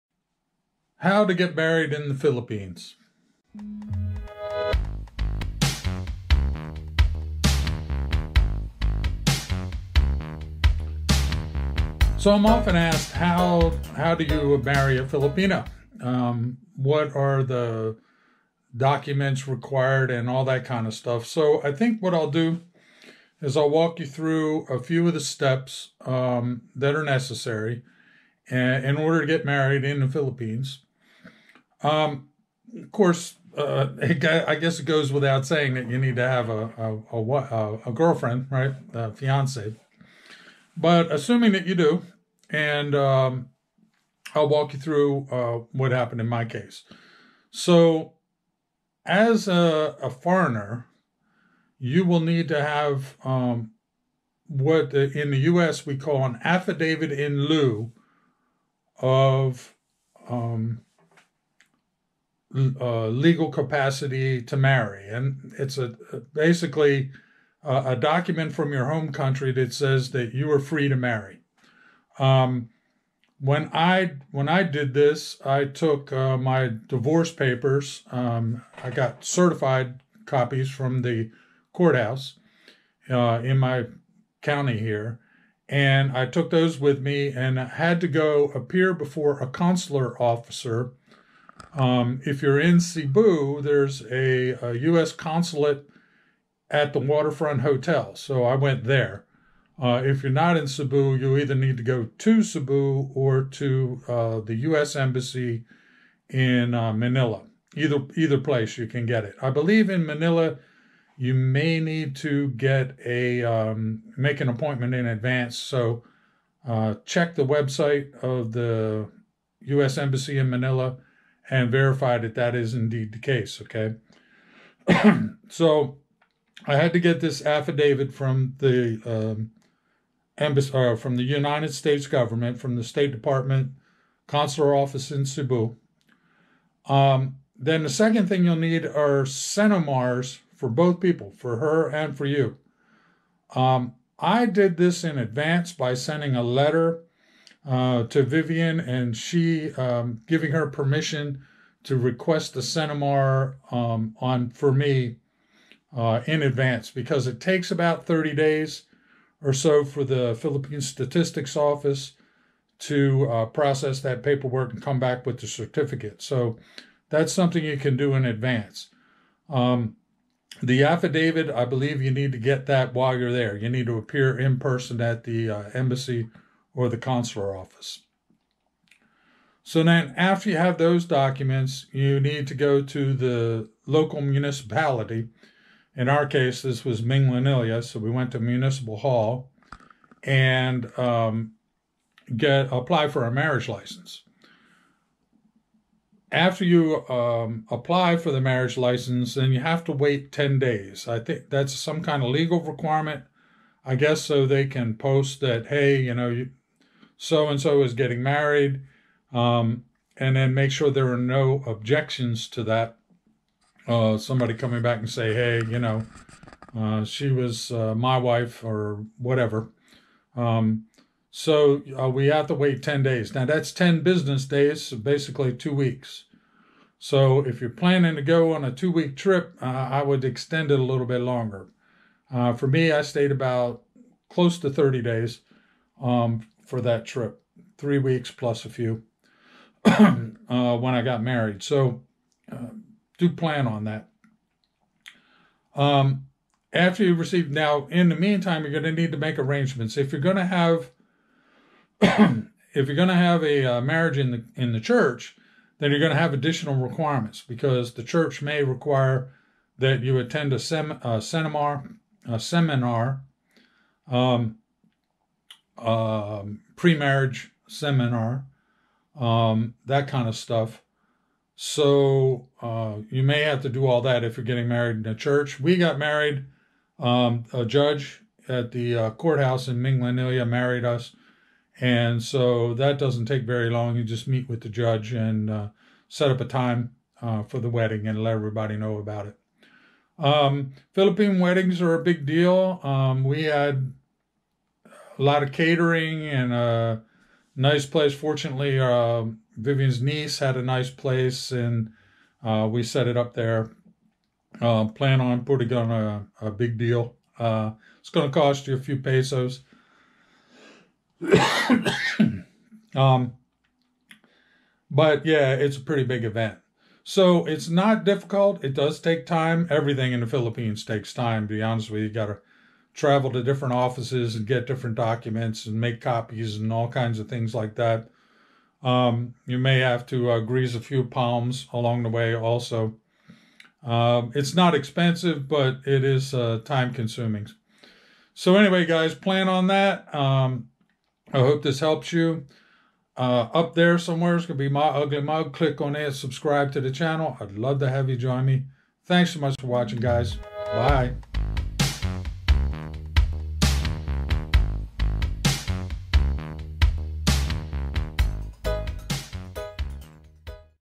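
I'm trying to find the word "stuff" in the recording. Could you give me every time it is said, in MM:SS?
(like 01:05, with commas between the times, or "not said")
00:20, 04:30.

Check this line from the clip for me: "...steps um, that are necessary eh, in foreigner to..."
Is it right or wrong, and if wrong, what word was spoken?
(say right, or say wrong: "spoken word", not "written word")
wrong: "order", not "foreigner".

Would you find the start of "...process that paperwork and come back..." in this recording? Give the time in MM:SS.
02:43.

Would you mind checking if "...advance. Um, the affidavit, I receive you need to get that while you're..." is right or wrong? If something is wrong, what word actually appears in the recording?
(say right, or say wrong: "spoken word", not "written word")
wrong: "believe", not "receive".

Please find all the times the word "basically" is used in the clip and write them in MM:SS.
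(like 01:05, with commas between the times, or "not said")
01:06, 03:44.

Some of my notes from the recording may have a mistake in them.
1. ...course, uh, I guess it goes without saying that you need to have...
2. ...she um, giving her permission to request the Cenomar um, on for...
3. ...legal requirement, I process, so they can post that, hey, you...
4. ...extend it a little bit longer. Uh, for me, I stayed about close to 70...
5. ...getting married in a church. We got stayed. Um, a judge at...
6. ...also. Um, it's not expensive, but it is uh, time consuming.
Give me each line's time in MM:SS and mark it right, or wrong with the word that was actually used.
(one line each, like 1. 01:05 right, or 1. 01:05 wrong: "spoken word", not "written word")
1. 00:32 right
2. 02:29 right
3. 03:22 wrong: "guess", not "process"
4. 03:50 wrong: "30", not "70"
5. 04:34 wrong: "married", not "stayed"
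6. 05:32 right.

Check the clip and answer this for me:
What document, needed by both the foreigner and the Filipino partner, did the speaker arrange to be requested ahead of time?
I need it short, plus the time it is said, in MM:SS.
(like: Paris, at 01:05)
Cenomar, at 02:19.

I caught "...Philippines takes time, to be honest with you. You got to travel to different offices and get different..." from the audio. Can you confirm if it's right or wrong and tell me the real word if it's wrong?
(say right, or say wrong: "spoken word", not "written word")
right.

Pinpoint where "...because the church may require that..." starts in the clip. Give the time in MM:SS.
04:17.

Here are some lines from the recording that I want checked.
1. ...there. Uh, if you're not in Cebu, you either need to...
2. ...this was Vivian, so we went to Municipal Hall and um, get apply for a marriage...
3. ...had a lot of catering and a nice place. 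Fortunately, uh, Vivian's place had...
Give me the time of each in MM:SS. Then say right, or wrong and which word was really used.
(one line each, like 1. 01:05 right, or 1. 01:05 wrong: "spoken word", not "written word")
1. 01:38 right
2. 03:06 wrong: "Minglanilla", not "Vivian"
3. 04:53 wrong: "niece", not "place".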